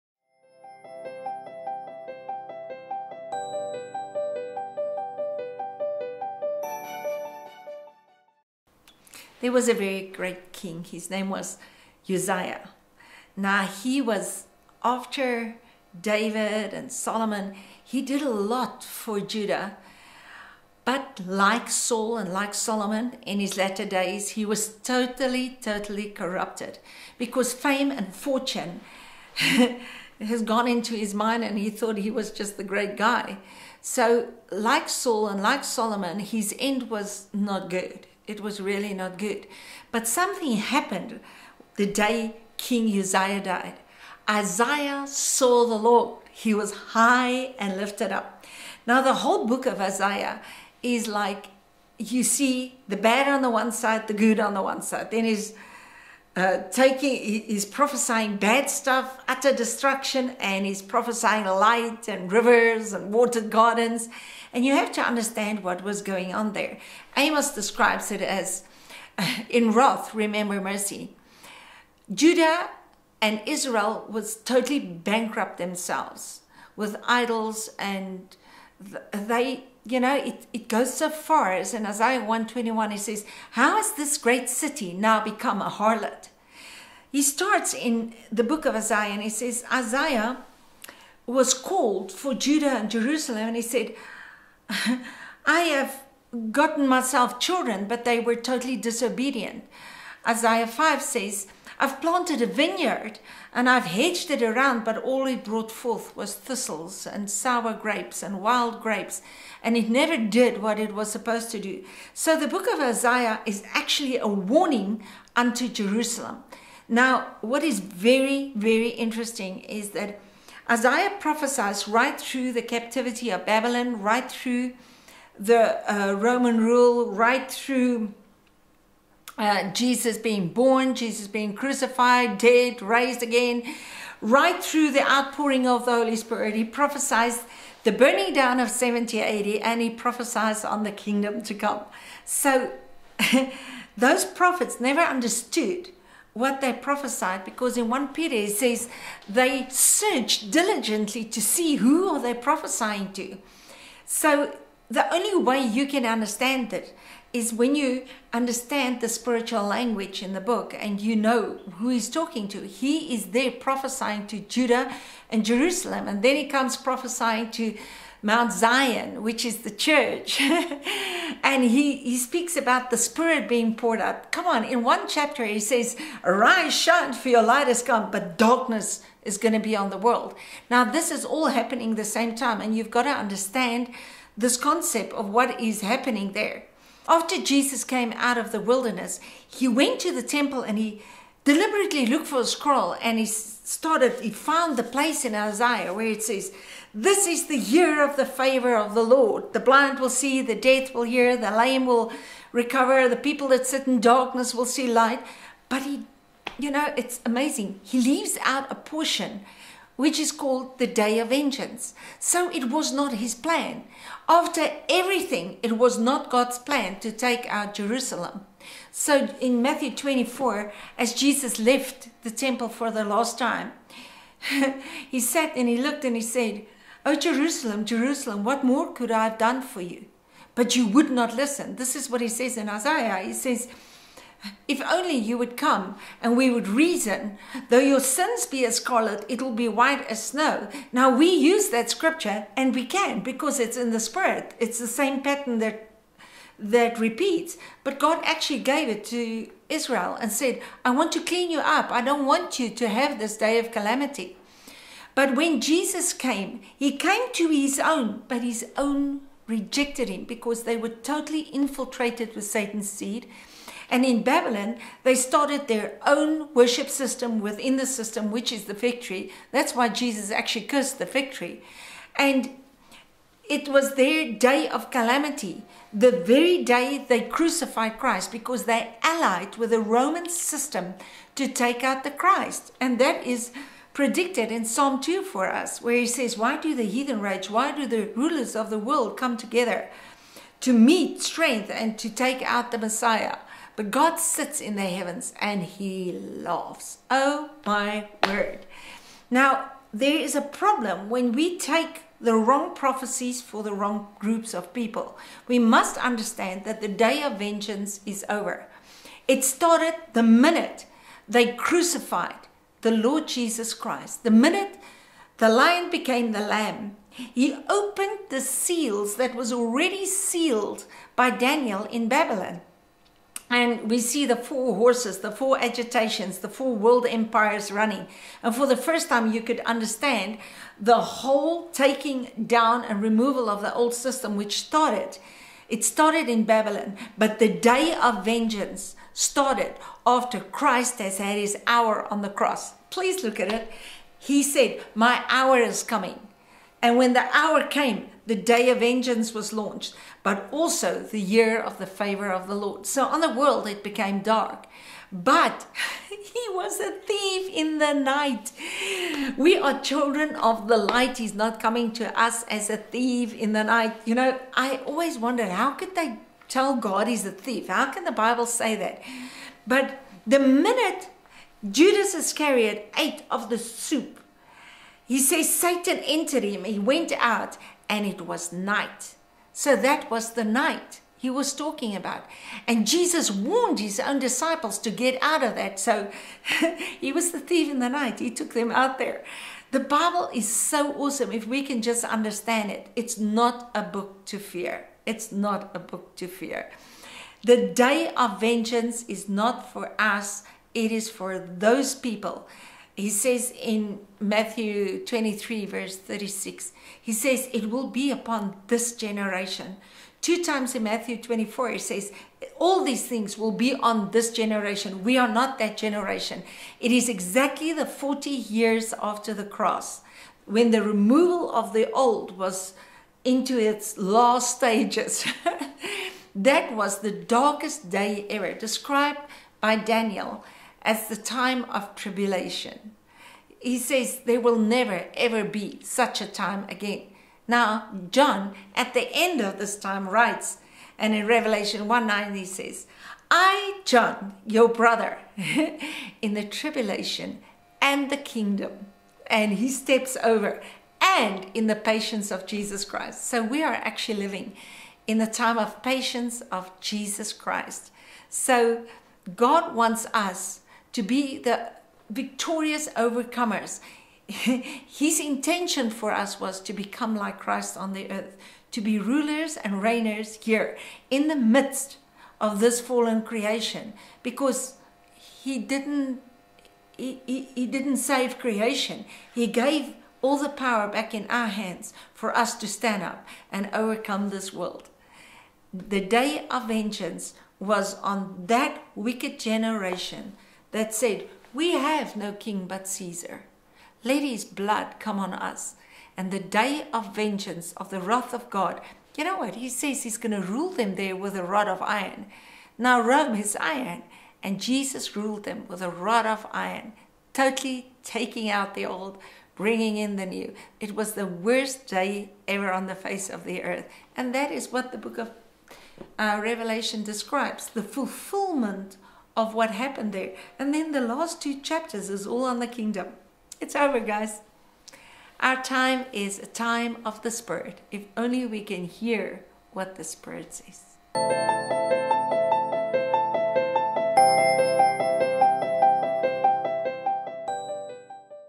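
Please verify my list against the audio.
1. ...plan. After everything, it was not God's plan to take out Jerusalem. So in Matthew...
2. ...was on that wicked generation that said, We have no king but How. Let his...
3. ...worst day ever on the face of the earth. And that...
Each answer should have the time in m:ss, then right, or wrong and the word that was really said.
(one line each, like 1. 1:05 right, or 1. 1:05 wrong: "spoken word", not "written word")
1. 3:33 right
2. 8:07 wrong: "Caesar", not "How"
3. 8:31 right.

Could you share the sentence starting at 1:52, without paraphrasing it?
So the book of Isaiah is actually a warning unto Jerusalem.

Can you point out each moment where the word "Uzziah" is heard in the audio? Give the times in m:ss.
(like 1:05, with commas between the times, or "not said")
0:12, 0:42.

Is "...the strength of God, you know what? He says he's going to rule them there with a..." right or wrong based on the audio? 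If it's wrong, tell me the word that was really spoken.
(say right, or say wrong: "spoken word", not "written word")
wrong: "wrath", not "strength".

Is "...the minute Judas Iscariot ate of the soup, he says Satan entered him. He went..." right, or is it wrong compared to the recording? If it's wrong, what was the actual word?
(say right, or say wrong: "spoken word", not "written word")
right.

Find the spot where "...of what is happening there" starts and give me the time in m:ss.
3:05.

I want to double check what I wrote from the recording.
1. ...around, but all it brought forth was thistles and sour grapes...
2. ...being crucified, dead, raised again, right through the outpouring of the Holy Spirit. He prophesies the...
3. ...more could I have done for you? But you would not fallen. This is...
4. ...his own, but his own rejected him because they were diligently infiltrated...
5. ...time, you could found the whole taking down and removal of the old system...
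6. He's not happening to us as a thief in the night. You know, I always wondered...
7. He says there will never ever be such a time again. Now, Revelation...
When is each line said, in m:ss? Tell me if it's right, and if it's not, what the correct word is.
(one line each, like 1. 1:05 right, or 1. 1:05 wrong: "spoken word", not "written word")
1. 1:44 right
2. 2:11 right
3. 3:48 wrong: "listen", not "fallen"
4. 4:17 wrong: "totally", not "diligently"
5. 5:29 wrong: "understand", not "found"
6. 6:01 wrong: "coming", not "happening"
7. 7:13 wrong: "John", not "Revelation".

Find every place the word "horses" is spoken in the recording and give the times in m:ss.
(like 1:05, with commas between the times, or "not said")
5:24.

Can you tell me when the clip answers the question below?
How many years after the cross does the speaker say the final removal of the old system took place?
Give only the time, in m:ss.
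6:57.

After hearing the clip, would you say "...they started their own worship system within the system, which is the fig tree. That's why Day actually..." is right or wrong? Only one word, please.
wrong.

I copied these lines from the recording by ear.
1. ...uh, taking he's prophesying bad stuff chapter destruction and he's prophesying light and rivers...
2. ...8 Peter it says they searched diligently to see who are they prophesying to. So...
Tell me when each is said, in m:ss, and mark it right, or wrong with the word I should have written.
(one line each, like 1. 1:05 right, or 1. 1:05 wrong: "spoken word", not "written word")
1. 0:56 wrong: "utter", not "chapter"
2. 2:27 wrong: "1", not "8".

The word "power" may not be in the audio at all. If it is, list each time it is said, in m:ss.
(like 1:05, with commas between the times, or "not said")
8:00.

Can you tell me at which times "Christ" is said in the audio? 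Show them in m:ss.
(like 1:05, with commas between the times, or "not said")
4:37, 4:42, 5:13, 5:40, 7:32, 7:37, 7:47.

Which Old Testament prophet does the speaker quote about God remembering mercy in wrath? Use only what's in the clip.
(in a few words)
Amos.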